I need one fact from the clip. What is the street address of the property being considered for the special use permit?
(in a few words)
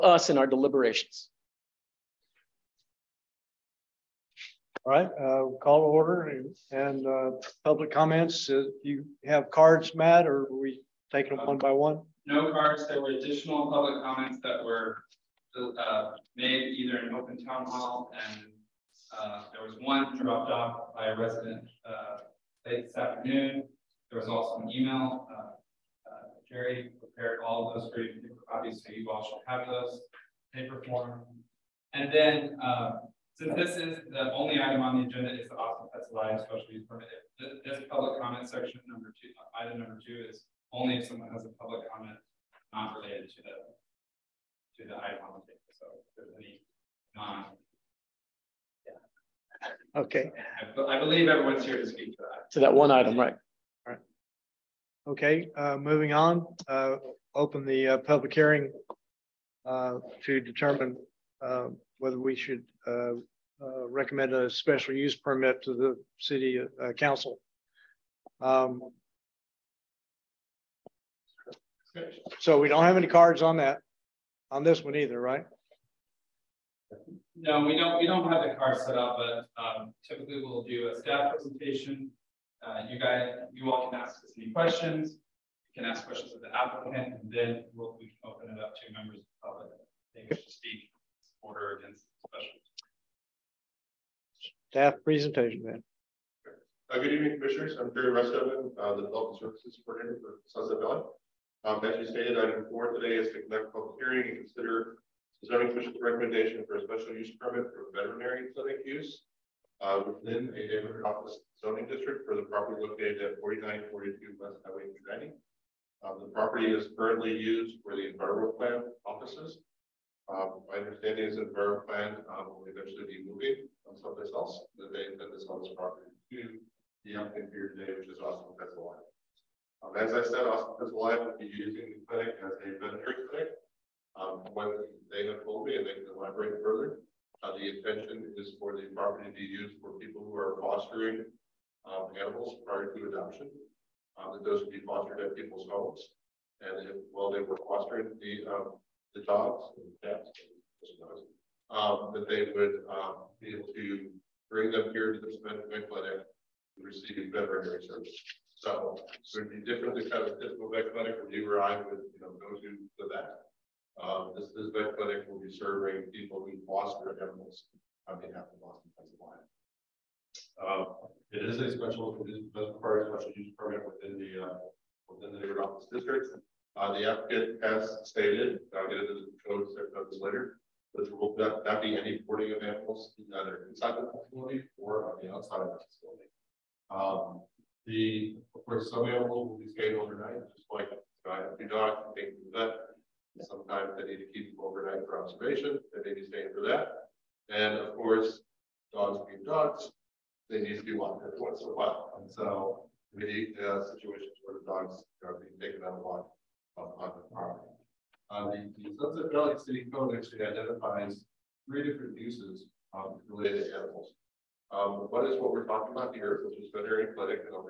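4942 West Highway 90.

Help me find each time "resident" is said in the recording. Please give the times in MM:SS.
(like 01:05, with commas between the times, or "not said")
00:21.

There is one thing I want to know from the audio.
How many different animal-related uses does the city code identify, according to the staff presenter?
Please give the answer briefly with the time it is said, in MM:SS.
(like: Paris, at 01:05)
3, at 03:31.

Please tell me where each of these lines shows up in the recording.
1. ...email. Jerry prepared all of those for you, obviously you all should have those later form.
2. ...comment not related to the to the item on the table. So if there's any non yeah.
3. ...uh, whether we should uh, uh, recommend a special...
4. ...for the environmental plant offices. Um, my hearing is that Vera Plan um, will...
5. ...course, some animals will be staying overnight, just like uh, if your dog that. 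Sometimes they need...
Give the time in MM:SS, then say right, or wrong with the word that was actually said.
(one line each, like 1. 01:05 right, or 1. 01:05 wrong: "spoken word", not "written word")
1. 00:24 wrong: "paper", not "later"
2. 00:41 right
3. 01:01 right
4. 01:57 wrong: "understanding", not "hearing"
5. 03:08 right.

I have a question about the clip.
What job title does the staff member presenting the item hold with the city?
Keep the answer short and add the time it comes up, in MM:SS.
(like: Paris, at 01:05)
Development Services Coordinator, at 01:39.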